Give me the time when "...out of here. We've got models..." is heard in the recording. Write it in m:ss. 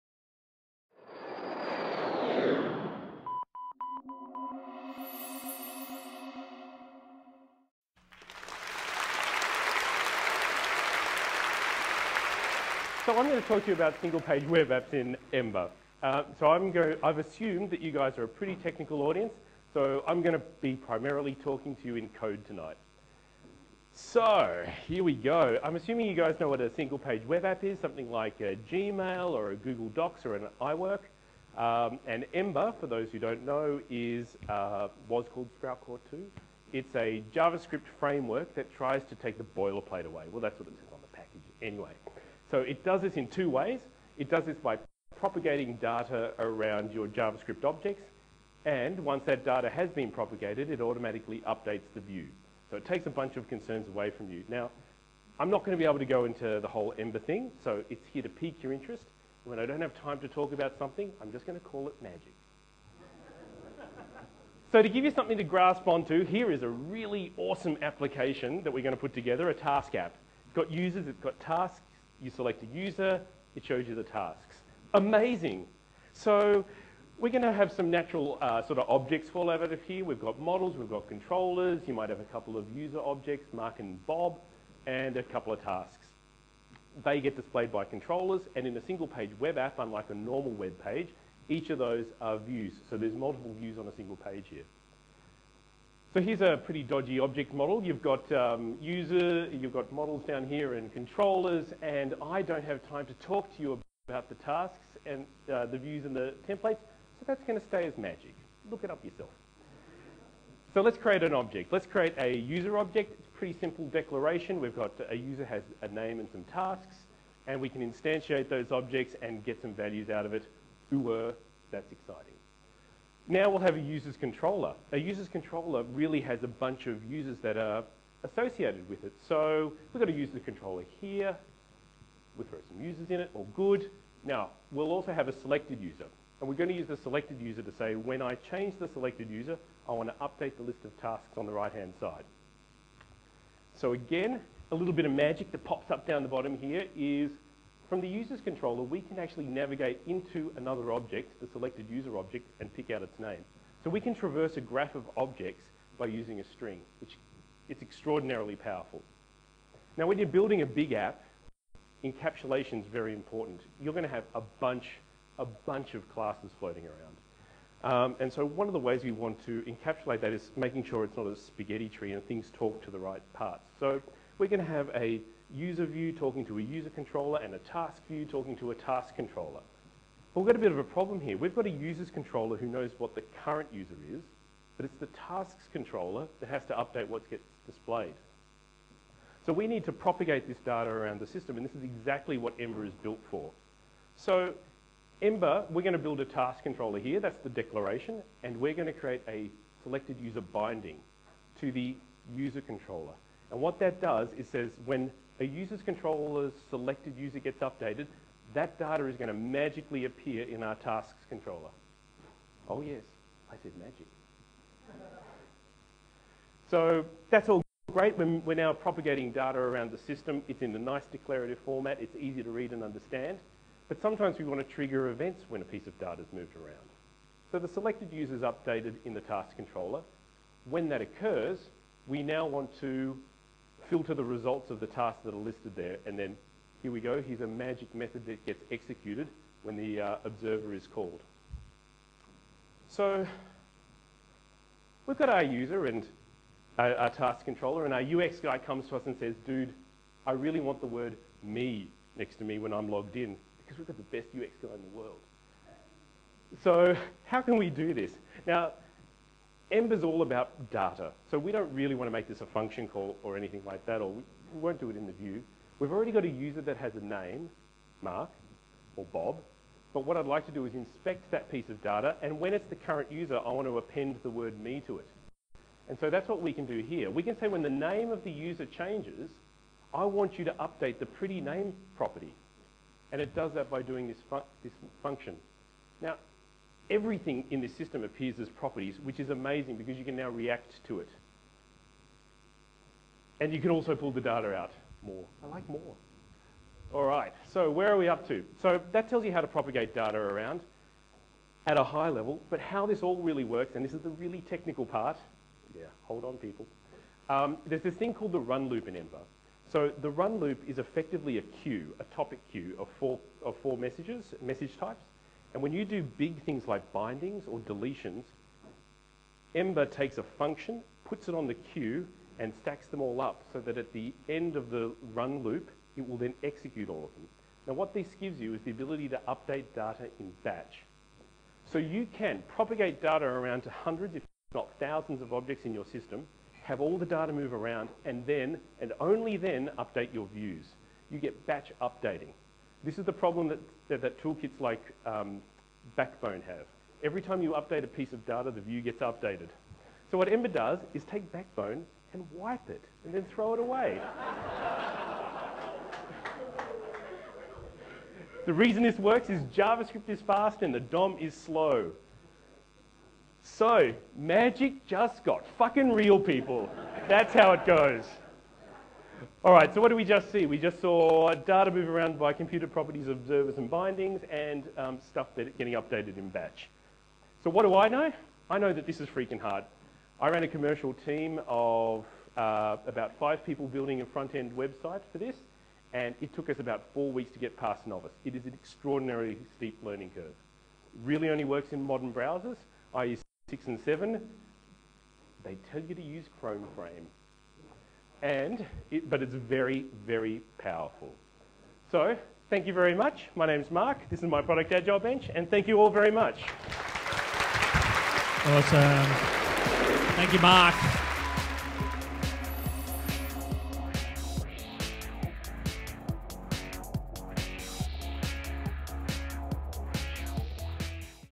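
1:19.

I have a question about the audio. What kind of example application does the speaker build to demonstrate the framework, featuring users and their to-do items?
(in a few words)
A task app.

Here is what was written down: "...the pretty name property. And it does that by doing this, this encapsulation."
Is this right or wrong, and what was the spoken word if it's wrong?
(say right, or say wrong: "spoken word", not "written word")
wrong: "function", not "encapsulation".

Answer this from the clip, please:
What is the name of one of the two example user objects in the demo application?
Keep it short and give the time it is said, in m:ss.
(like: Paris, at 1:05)
Mark or Bob, at 1:23.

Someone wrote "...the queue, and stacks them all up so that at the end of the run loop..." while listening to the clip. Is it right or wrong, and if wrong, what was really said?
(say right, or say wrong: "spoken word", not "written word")
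right.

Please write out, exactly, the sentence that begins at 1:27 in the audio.
They get displayed by controllers, and in a single page web app, unlike a normal web page, each of those are views.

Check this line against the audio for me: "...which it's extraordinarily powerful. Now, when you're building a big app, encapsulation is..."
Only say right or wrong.
right.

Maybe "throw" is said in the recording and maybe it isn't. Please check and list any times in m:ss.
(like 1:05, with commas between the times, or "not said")
2:12, 5:53.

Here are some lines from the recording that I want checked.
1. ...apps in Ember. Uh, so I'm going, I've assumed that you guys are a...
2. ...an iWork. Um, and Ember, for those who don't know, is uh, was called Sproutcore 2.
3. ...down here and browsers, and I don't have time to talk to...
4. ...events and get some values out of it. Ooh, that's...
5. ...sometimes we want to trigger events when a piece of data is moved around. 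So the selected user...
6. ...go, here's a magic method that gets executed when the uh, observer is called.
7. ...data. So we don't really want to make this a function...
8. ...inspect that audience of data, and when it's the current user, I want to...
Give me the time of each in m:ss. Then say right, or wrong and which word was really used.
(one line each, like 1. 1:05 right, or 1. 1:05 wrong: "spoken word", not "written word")
1. 0:14 right
2. 0:30 right
3. 1:40 wrong: "controllers", not "browsers"
4. 1:58 wrong: "objects", not "events"
5. 3:44 right
6. 3:57 right
7. 4:20 right
8. 4:30 wrong: "piece", not "audience".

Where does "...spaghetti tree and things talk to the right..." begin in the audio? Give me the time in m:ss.
2:51.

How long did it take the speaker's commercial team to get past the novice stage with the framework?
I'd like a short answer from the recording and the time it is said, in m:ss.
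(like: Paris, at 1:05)
4 weeks, at 6:26.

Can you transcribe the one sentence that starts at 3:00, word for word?
But we've got a bit of a problem here.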